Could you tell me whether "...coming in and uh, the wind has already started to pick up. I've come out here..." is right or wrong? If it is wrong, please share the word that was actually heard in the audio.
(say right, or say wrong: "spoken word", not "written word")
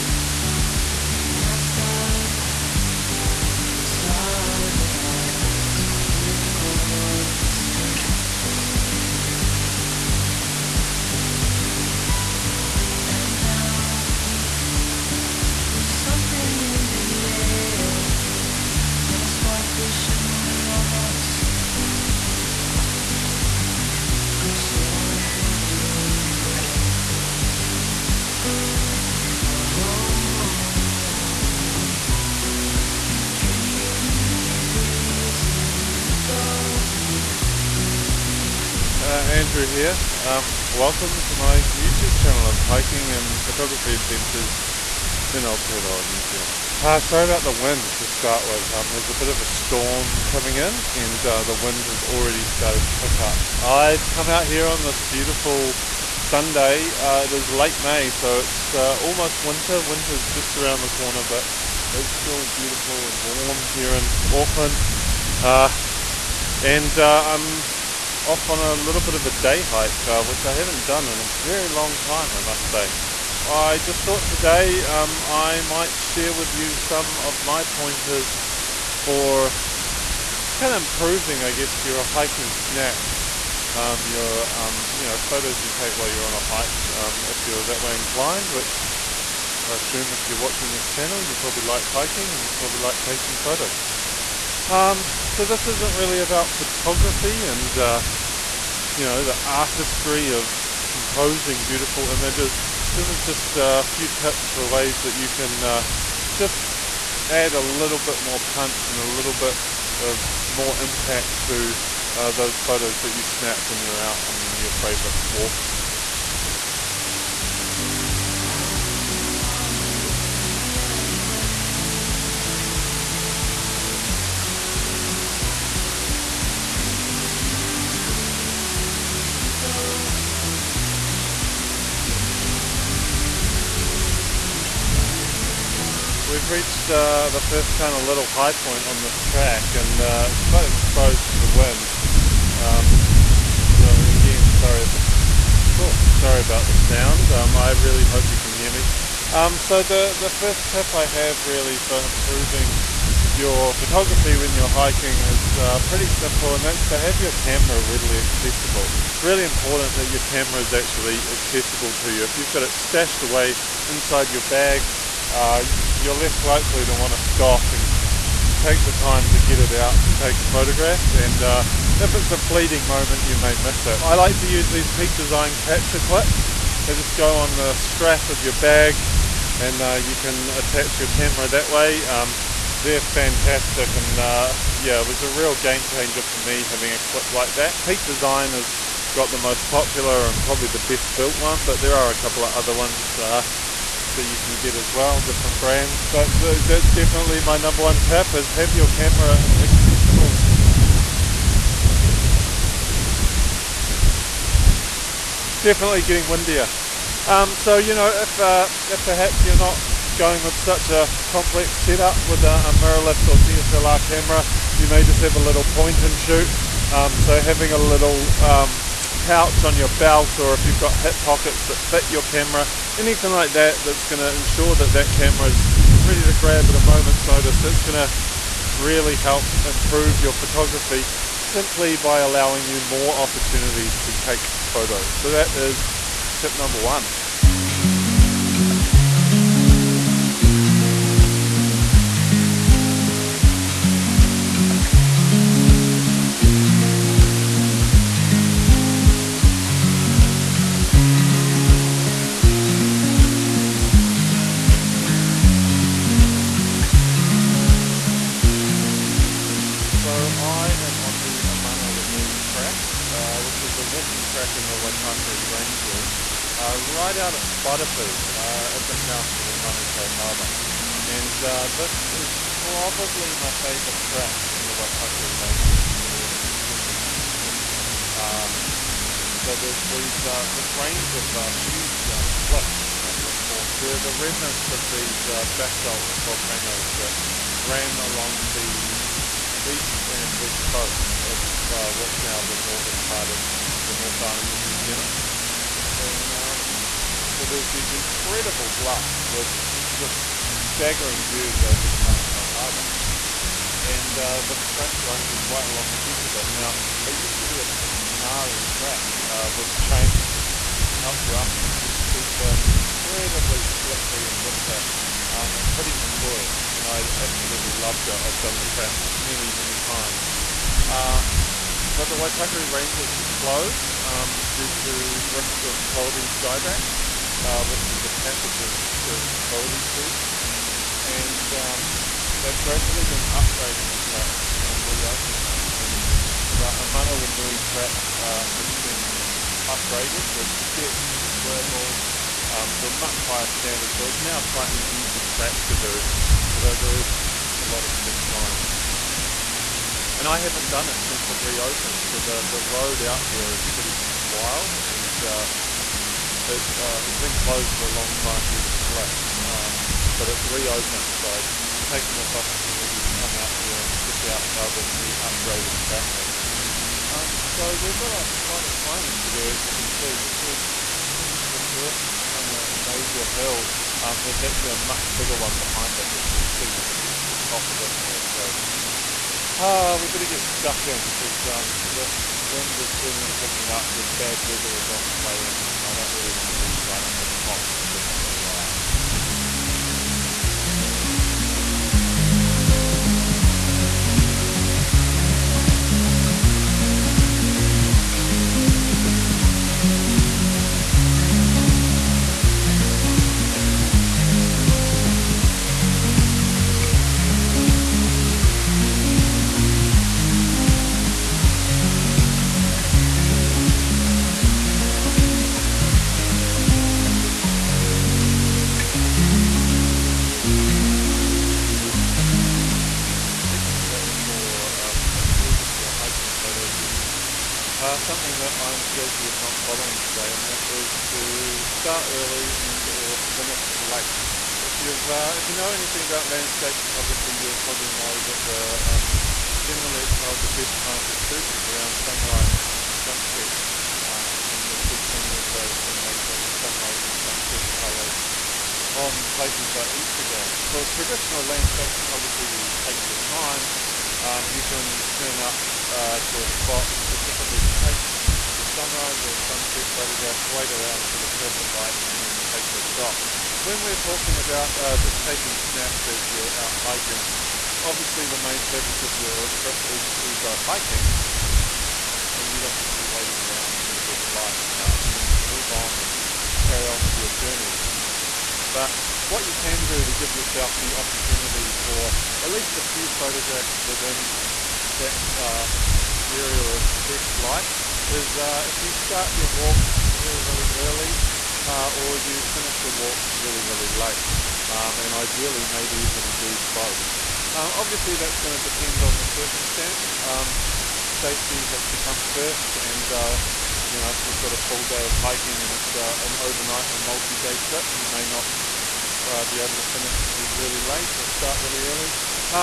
right.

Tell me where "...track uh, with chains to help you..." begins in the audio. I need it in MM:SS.
05:08.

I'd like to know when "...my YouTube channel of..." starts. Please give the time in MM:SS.
00:41.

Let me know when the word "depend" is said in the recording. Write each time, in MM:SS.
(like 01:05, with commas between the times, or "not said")
08:18.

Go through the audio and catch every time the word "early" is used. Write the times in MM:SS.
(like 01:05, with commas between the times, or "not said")
07:12, 08:10, 08:31.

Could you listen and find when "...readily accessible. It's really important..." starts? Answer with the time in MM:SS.
02:37.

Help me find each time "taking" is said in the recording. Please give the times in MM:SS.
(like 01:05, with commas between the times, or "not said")
01:33, 07:45.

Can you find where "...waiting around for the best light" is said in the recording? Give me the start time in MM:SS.
07:53.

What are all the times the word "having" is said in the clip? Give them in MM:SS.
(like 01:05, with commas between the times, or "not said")
03:06, 03:37.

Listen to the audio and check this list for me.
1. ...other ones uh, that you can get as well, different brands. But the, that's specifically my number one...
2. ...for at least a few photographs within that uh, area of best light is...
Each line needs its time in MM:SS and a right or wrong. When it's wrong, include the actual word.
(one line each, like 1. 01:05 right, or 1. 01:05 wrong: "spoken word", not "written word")
1. 03:12 wrong: "definitely", not "specifically"
2. 08:01 right.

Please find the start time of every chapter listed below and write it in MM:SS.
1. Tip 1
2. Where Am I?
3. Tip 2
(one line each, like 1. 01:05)
1. 02:14
2. 04:18
3. 07:02.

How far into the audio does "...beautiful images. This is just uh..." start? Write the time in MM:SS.
01:41.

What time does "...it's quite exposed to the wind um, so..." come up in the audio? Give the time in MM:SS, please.
02:20.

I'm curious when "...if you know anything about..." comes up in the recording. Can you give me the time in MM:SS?
07:15.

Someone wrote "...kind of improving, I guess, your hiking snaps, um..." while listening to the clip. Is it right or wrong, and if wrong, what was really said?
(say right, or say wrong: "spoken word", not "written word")
right.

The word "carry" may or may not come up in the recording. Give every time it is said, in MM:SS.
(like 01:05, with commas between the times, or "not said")
07:56.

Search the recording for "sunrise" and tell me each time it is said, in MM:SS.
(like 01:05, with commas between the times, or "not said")
07:21, 07:26, 07:38.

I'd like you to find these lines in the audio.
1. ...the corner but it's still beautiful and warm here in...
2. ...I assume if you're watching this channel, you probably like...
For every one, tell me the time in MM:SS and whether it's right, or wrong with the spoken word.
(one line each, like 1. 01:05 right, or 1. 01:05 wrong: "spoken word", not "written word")
1. 01:00 right
2. 01:29 right.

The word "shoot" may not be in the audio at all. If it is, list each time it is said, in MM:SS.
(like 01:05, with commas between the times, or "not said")
03:36, 07:21.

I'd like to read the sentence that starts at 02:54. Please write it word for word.
I like to use these Peak Design capture clips.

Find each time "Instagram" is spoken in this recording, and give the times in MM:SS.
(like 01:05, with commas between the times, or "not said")
07:29.